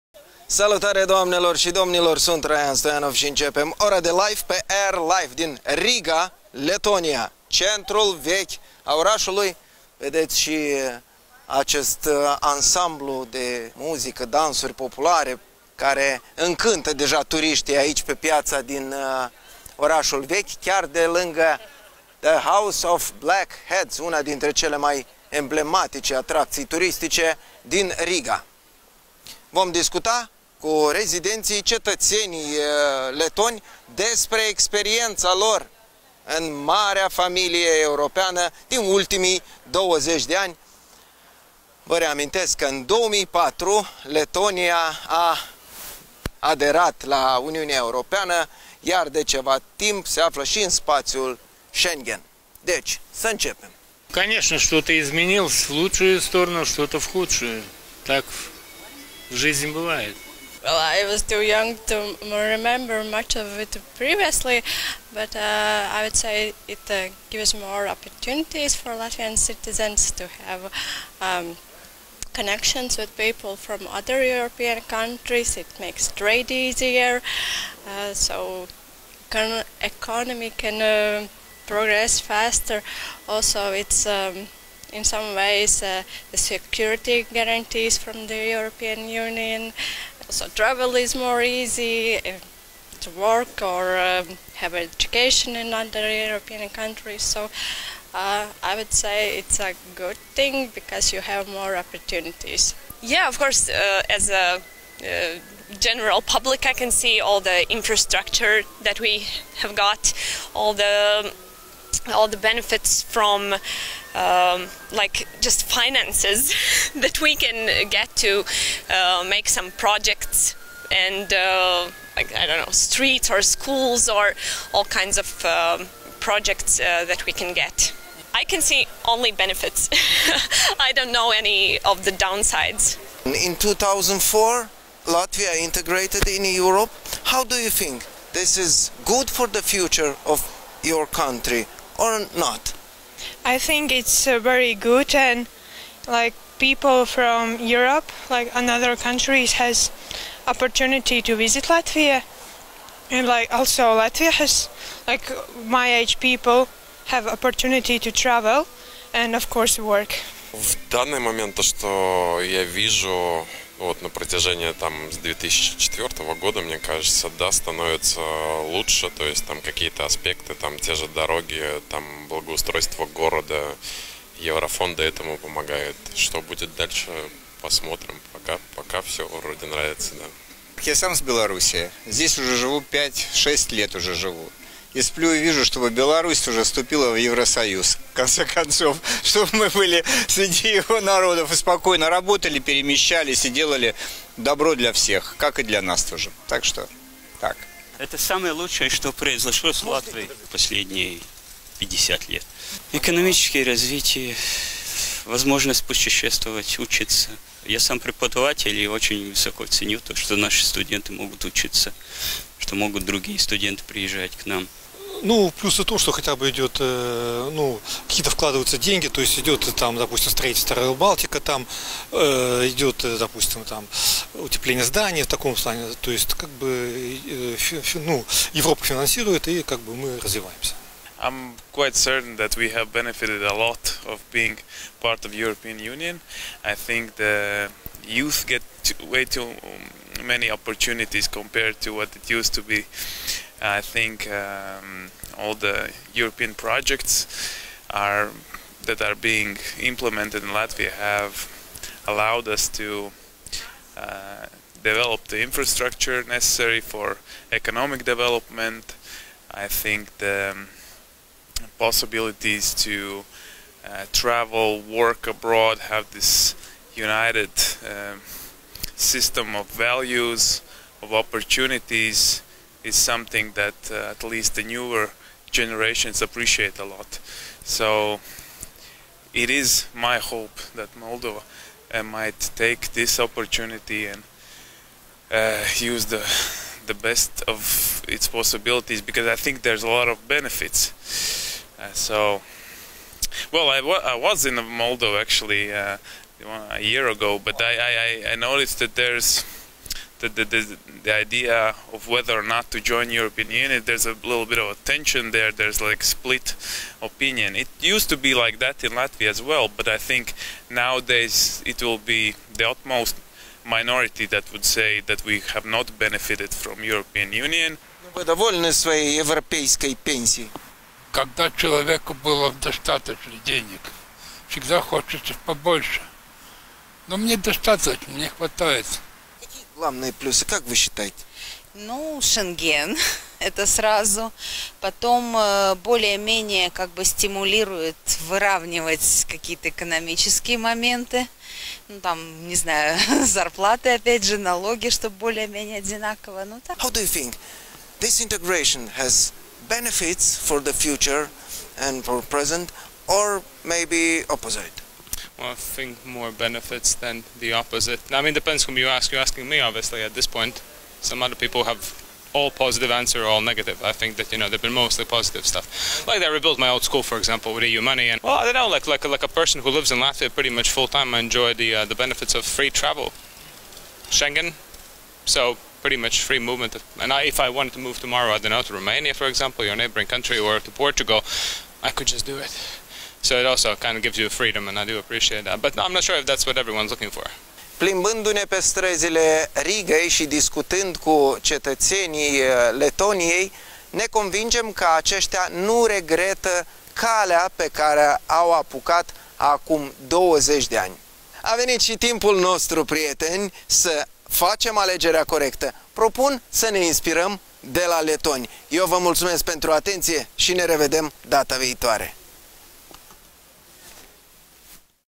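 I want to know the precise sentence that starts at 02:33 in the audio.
And like also Latvia has like my age people have opportunity to travel and of course work.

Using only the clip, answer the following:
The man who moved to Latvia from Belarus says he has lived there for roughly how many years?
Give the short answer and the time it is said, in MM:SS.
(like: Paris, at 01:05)
5-6 years, at 03:02.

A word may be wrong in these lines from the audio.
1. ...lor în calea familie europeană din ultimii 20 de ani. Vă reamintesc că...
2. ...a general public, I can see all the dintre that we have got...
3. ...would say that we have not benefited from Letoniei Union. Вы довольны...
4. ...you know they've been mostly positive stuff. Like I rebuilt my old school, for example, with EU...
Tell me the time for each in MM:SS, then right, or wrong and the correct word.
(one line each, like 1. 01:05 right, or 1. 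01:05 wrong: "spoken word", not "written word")
1. 00:35 wrong: "marea", not "calea"
2. 01:44 wrong: "infrastructure", not "dintre"
3. 05:14 wrong: "European", not "Letoniei"
4. 06:04 right.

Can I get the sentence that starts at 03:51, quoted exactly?
I'm quite certain that we have benefited a lot of being part of European Union.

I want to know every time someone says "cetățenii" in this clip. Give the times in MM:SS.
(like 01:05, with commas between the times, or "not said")
00:31, 06:31.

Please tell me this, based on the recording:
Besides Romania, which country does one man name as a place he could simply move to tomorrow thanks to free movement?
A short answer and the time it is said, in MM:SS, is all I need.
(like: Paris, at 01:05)
Portugal, at 06:20.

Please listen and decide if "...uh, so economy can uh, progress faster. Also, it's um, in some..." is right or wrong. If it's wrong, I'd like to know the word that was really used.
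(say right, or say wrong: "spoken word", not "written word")
right.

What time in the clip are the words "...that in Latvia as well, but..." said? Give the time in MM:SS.
05:08.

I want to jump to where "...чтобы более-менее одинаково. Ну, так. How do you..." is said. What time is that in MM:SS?
05:44.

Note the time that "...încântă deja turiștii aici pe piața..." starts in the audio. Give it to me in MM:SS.
00:16.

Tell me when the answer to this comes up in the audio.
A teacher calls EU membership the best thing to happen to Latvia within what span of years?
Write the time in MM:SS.
03:21.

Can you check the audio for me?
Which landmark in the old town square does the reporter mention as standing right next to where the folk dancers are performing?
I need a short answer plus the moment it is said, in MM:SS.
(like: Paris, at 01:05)
House of Black Heads, at 00:22.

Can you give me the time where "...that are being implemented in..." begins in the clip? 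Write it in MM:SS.
04:08.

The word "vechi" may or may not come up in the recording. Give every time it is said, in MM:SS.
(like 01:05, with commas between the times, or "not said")
00:08, 00:20.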